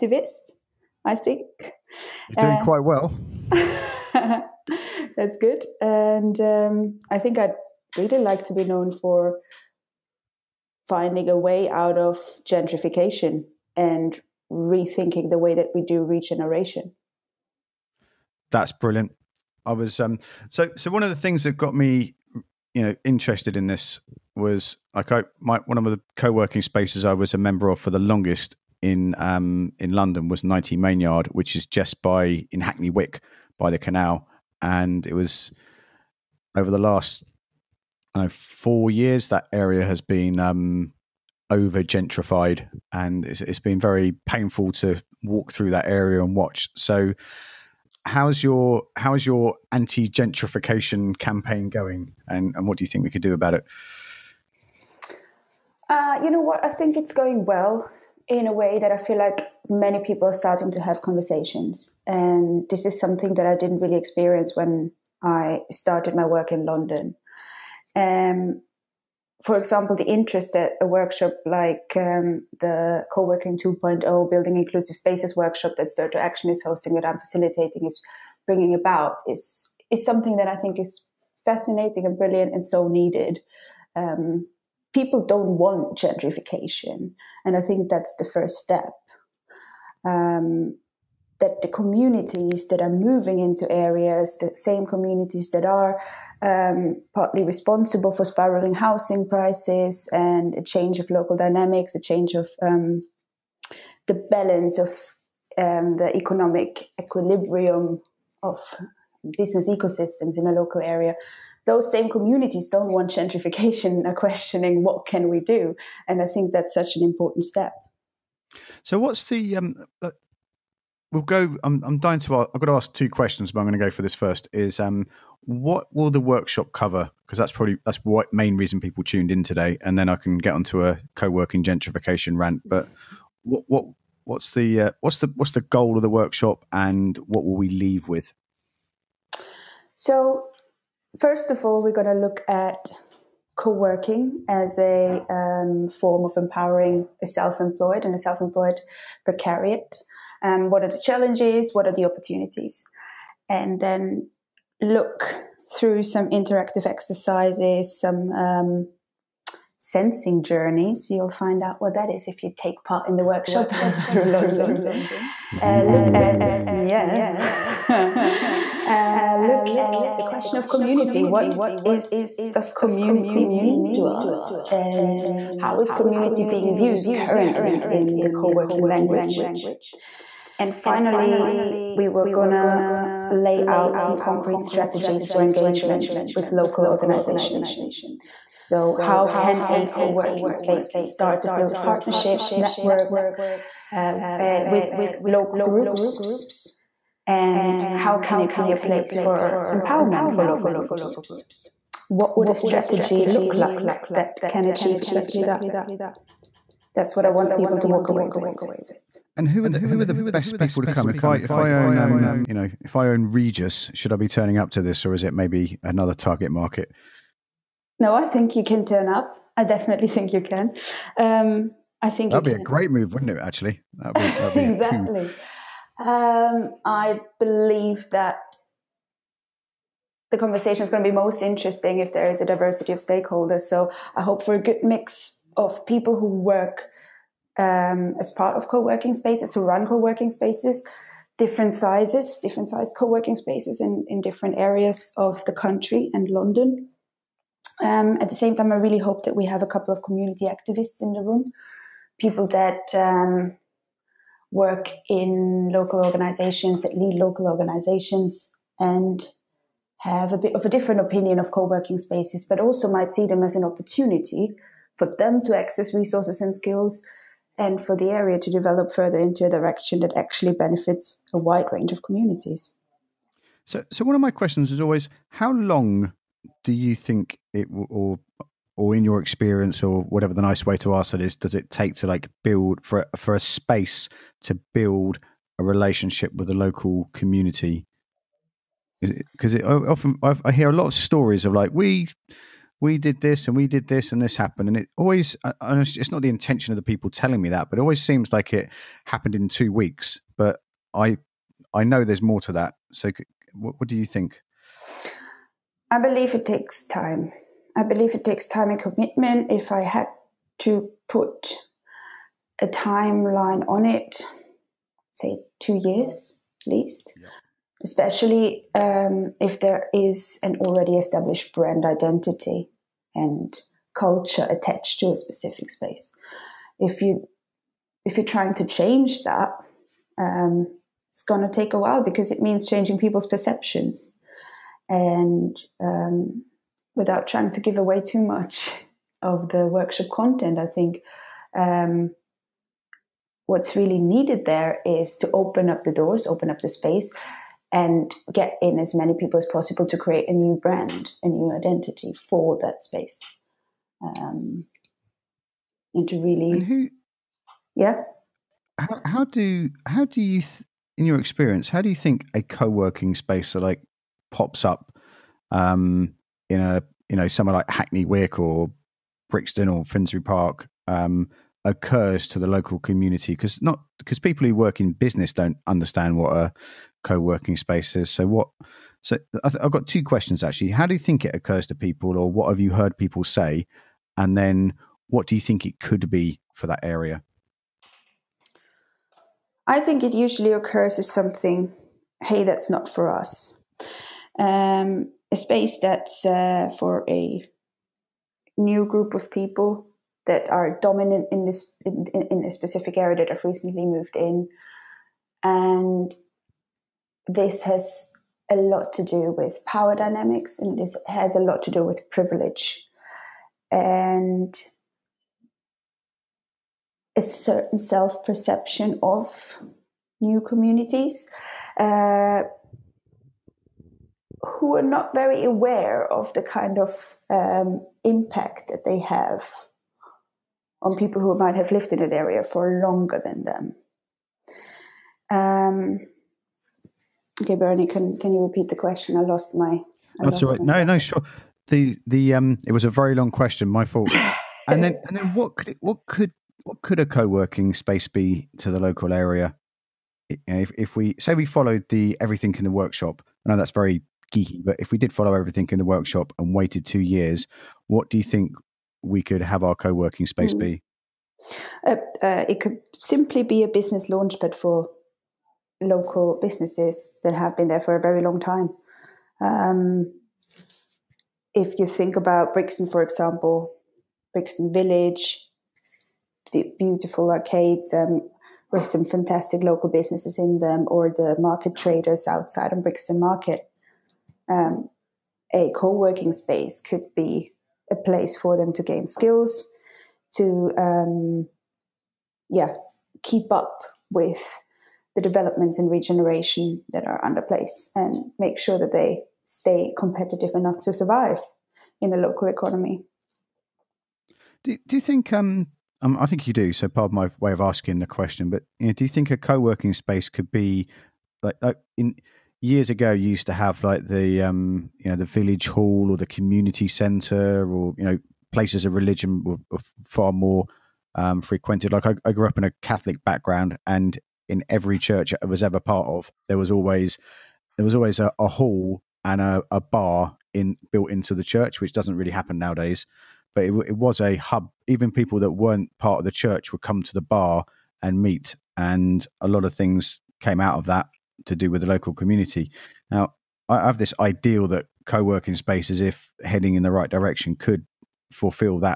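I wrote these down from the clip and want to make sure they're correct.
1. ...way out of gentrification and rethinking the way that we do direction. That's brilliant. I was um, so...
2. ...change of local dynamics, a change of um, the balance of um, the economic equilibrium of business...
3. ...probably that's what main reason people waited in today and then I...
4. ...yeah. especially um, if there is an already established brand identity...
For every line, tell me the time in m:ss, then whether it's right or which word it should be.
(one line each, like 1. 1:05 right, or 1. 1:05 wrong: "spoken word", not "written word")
1. 0:11 wrong: "regeneration", not "direction"
2. 1:40 right
3. 2:07 wrong: "tuned", not "waited"
4. 5:17 right.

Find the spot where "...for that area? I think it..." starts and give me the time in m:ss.
6:26.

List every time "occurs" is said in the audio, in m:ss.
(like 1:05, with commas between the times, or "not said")
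6:11, 6:21, 6:30.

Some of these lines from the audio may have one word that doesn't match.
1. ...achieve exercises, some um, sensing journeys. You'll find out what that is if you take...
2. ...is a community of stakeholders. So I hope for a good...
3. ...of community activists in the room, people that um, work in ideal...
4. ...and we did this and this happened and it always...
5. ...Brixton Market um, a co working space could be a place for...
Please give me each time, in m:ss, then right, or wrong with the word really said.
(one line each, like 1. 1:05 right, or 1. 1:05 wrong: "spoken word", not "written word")
1. 2:36 wrong: "interactive", not "achieve"
2. 3:52 wrong: "diversity", not "community"
3. 4:09 wrong: "local", not "ideal"
4. 4:53 right
5. 8:02 right.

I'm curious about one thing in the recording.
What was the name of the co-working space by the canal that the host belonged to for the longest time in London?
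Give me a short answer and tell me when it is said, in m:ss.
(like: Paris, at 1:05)
19 Main Yard, at 0:30.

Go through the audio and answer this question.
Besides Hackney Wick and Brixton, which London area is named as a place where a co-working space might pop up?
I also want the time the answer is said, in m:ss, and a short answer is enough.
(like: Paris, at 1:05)
Finsbury Park, at 6:09.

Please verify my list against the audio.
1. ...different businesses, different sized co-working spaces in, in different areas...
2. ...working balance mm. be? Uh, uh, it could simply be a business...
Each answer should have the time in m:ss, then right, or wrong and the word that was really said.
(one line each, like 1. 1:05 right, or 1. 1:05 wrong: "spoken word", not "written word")
1. 4:01 wrong: "sizes", not "businesses"
2. 7:39 wrong: "space", not "balance".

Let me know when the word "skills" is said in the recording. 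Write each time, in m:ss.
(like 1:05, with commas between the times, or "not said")
4:26, 8:09.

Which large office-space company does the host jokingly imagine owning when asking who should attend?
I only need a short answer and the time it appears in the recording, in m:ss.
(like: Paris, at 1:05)
Regus, at 3:33.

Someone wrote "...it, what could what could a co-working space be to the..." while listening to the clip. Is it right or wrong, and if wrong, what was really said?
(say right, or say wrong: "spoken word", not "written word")
right.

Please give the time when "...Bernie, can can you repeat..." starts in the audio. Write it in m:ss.
7:17.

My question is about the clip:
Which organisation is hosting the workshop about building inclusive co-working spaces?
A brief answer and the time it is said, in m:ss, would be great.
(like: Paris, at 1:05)
Stir to Action, at 1:15.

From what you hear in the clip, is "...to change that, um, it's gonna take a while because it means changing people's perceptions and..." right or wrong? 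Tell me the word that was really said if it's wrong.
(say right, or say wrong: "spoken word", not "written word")
right.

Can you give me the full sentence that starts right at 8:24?
Do, do you think um, um, I think you do.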